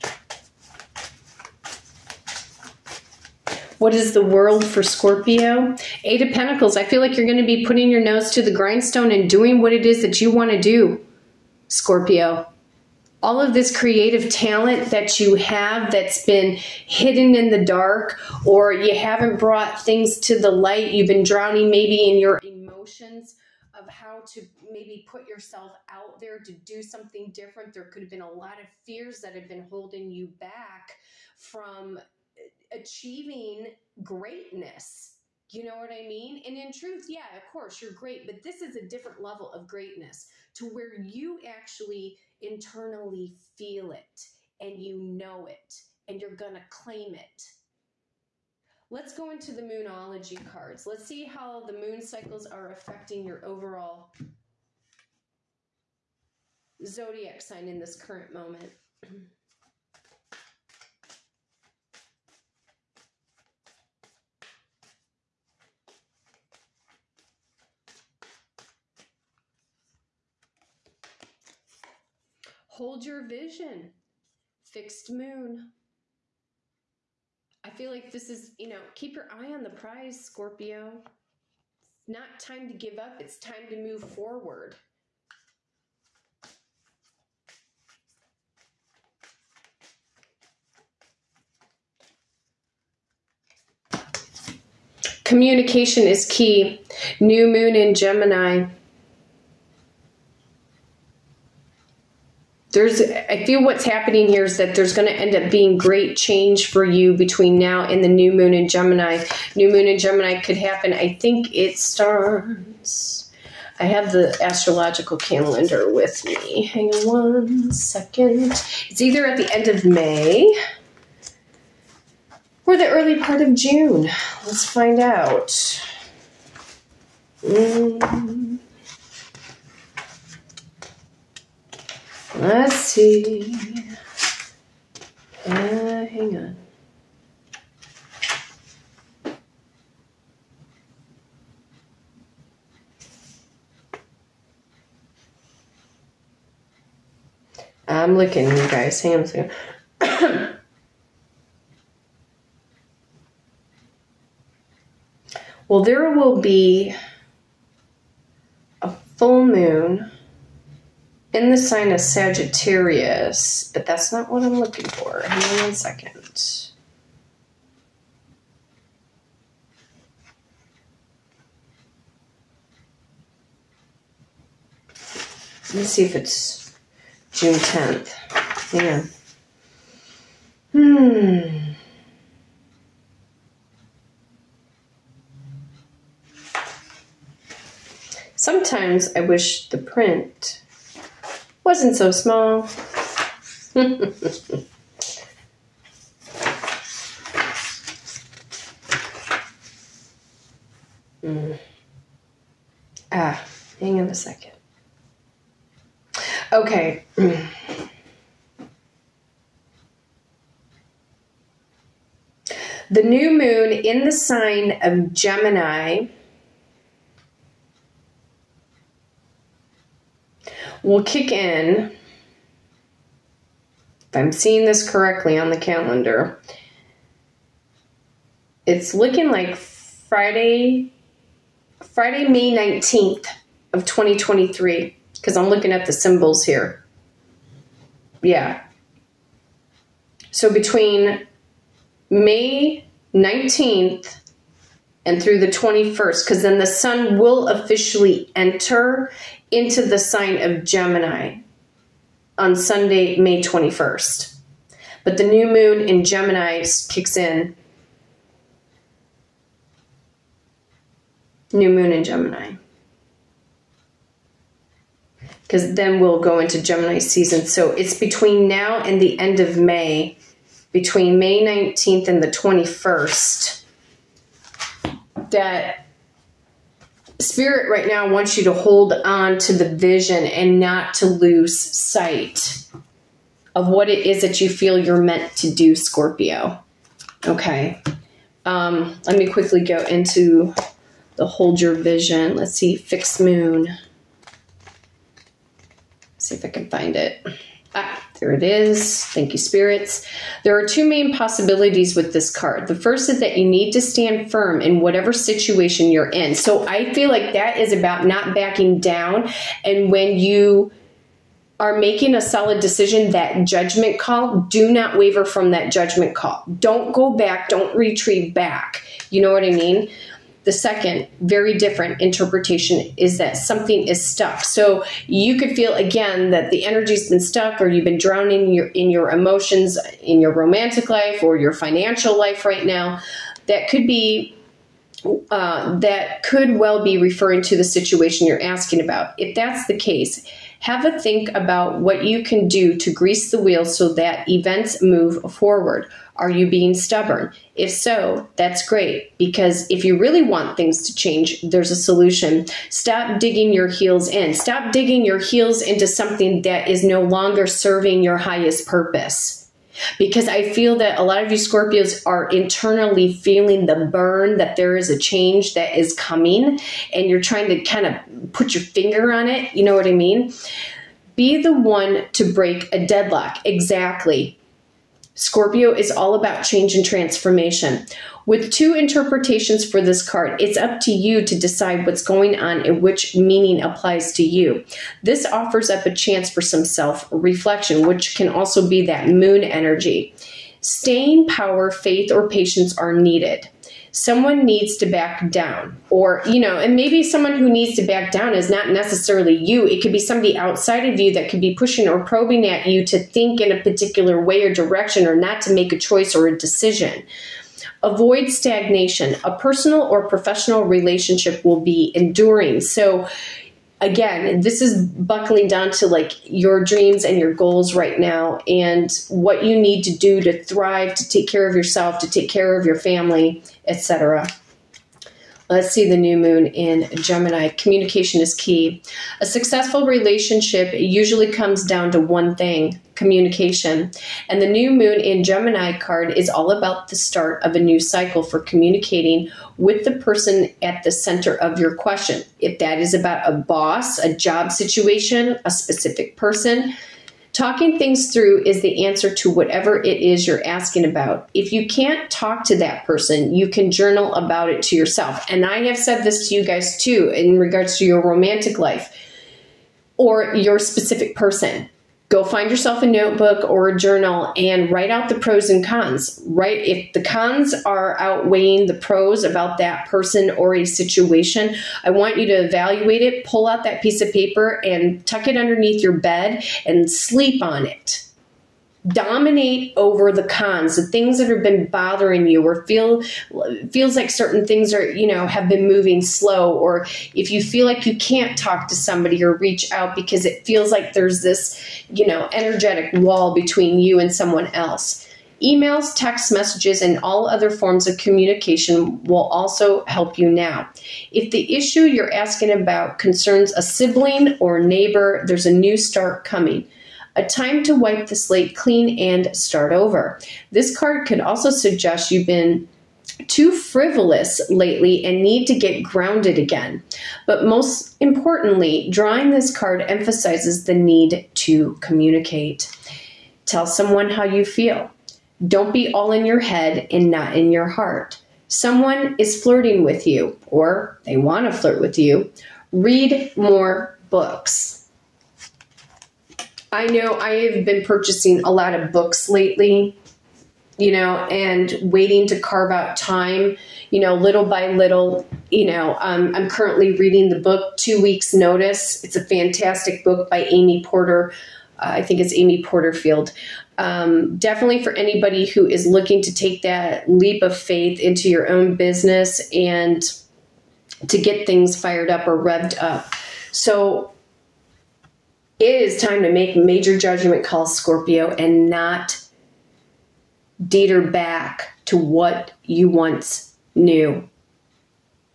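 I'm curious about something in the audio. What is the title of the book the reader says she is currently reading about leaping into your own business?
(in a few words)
Two Weeks Notice.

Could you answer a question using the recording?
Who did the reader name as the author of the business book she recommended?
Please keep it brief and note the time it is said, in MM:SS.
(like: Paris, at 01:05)
Amy Porterfield, at 09:12.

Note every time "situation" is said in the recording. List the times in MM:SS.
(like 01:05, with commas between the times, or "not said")
05:05, 05:37, 07:24, 07:50.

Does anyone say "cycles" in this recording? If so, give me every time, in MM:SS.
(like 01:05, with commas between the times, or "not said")
00:51, 07:17.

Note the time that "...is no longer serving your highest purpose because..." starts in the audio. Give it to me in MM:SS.
05:56.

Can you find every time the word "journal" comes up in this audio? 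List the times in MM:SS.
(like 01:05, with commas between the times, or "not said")
07:33, 07:43.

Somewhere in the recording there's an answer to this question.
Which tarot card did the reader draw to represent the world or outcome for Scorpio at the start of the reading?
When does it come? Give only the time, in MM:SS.
00:06.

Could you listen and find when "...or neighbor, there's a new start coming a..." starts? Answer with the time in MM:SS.
08:24.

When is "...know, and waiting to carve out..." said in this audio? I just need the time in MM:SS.
09:00.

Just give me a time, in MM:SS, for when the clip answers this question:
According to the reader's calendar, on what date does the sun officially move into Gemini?
04:12.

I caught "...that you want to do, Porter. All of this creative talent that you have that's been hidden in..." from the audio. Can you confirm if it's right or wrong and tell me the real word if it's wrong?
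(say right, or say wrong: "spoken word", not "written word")
wrong: "Scorpio", not "Porter".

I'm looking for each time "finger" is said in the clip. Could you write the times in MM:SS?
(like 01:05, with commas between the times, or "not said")
06:08.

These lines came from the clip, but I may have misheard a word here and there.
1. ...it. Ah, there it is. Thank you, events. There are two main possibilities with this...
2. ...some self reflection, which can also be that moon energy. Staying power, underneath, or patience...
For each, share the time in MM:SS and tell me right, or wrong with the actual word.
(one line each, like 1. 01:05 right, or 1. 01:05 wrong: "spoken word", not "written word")
1. 04:56 wrong: "spirits", not "events"
2. 06:26 wrong: "faith", not "underneath".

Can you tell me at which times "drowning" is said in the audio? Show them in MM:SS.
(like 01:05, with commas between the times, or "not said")
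00:21, 05:27.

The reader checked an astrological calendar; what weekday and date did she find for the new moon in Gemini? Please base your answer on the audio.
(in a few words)
Friday, May 19th.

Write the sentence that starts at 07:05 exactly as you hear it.
Let's see the new moon in Gemini.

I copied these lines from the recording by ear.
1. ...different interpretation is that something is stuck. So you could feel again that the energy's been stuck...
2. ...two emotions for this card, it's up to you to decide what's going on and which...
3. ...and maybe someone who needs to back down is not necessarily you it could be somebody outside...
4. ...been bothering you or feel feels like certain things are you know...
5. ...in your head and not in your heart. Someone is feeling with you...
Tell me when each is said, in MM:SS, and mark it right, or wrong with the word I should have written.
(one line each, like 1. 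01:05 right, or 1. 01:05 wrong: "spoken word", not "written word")
1. 05:21 right
2. 06:18 wrong: "interpretations", not "emotions"
3. 06:36 right
4. 08:01 right
5. 08:46 wrong: "flirting", not "feeling".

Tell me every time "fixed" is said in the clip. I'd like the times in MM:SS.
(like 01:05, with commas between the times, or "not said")
01:14, 04:52.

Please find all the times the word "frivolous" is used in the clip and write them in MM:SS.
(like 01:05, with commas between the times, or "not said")
08:33.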